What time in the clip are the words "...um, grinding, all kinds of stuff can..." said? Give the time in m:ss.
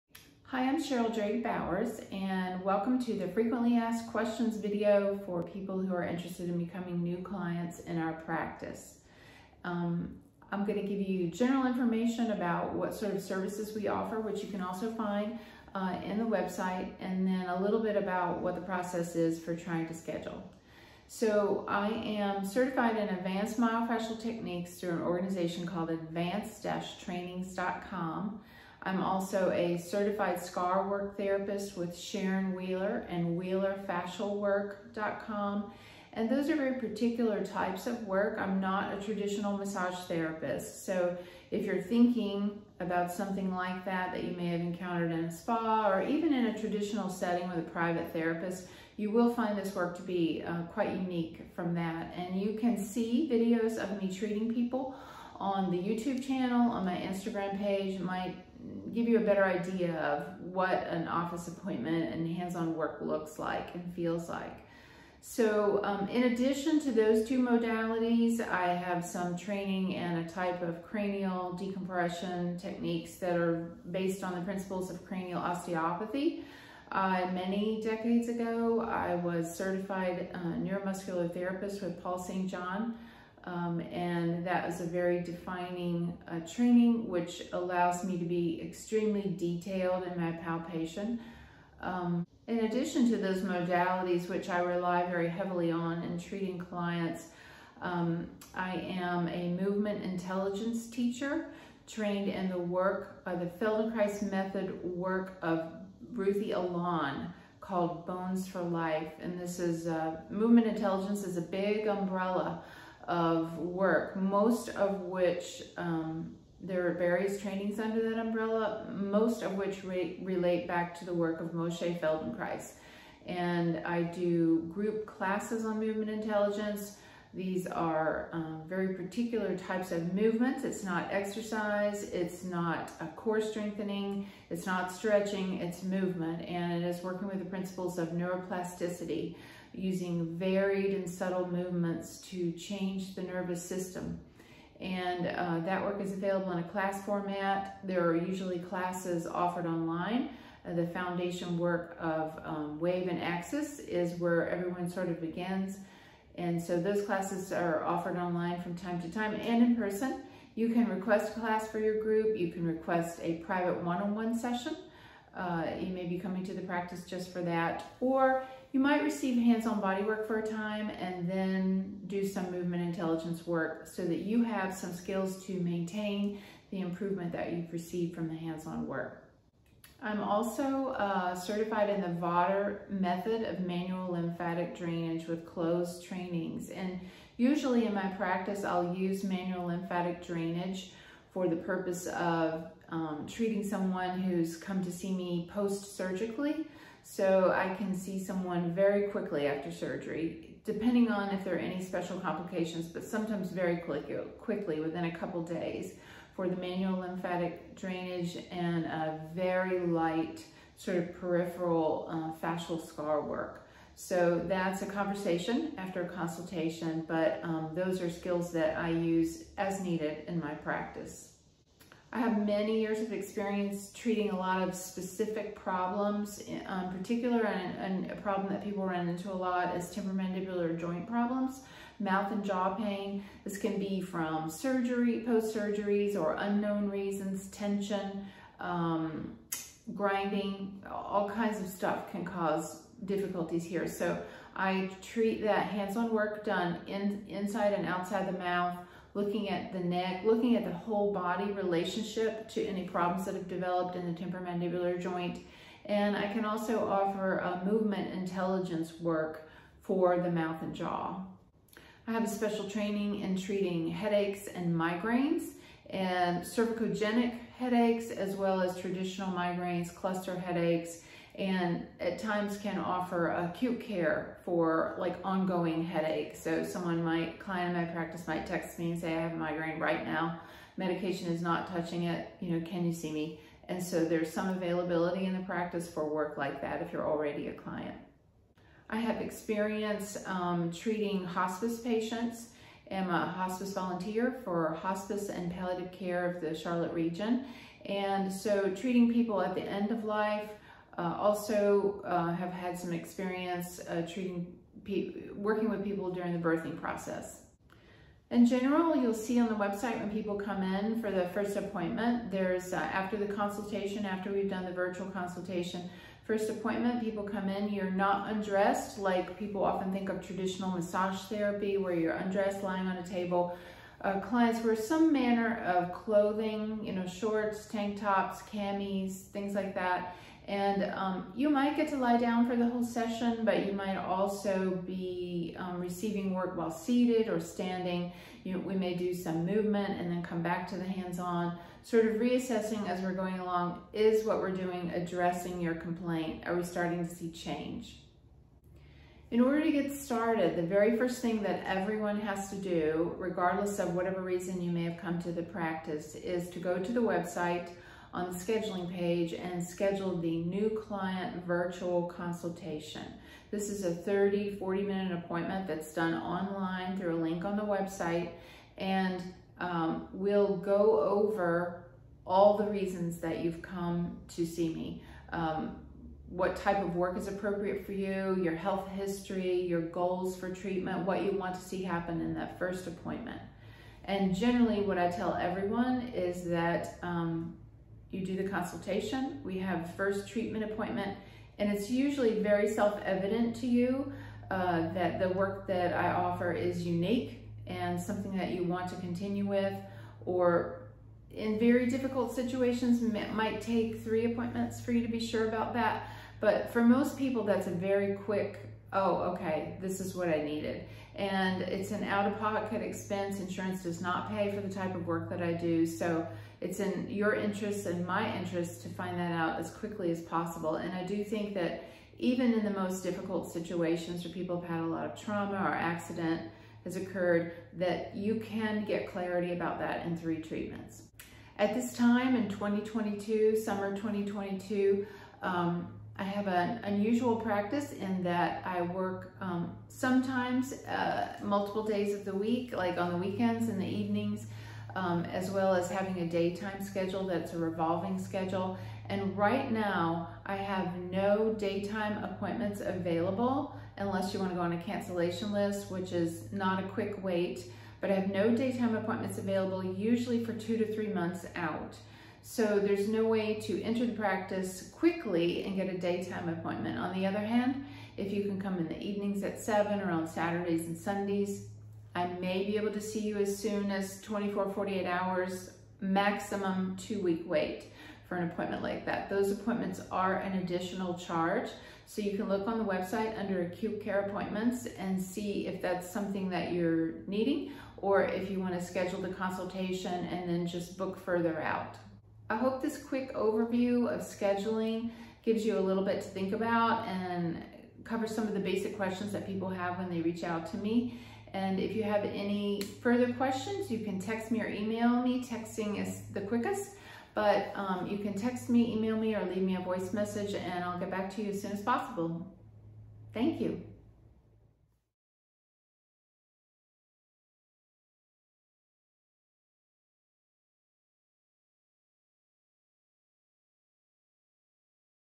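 3:58.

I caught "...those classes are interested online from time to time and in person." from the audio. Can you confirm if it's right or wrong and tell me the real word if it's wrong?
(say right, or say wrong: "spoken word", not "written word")
wrong: "offered", not "interested".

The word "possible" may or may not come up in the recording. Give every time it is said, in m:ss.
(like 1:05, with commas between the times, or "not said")
7:00, 8:31.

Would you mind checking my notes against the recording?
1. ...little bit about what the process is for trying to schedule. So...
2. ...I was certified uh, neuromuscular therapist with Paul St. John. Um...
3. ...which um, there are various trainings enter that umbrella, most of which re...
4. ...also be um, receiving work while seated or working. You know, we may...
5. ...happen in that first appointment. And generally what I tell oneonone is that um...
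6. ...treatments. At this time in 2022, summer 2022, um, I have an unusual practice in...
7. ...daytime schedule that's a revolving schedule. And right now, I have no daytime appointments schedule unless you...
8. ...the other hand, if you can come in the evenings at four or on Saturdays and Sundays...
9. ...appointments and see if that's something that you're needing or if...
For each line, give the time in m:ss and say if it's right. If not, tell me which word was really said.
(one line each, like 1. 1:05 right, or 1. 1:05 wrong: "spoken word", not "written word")
1. 0:17 right
2. 1:18 right
3. 1:55 wrong: "under", not "enter"
4. 5:33 wrong: "standing", not "working"
5. 6:21 wrong: "everyone", not "oneonone"
6. 7:10 right
7. 7:26 wrong: "available", not "schedule"
8. 7:47 wrong: "seven", not "four"
9. 8:04 right.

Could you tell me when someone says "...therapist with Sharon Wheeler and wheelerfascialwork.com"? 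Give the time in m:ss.
0:31.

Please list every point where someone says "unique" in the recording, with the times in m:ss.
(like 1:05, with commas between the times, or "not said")
0:50, 6:36.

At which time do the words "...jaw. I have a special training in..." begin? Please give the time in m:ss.
4:20.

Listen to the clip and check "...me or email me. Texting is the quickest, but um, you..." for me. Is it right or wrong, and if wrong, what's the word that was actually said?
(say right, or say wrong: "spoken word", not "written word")
right.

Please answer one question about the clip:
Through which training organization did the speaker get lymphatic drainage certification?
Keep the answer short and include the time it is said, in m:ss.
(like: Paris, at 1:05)
Klose trainings, at 3:05.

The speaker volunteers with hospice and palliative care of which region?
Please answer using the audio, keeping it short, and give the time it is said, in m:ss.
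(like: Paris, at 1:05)
Charlotte, at 4:56.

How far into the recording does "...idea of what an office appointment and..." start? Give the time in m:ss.
0:59.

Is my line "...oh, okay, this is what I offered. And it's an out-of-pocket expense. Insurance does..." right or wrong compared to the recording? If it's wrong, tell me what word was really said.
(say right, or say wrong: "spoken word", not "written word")
wrong: "needed", not "offered".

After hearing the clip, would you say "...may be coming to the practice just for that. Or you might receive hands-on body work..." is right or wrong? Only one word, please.
right.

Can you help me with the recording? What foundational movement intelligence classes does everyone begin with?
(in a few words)
Wave and Axis.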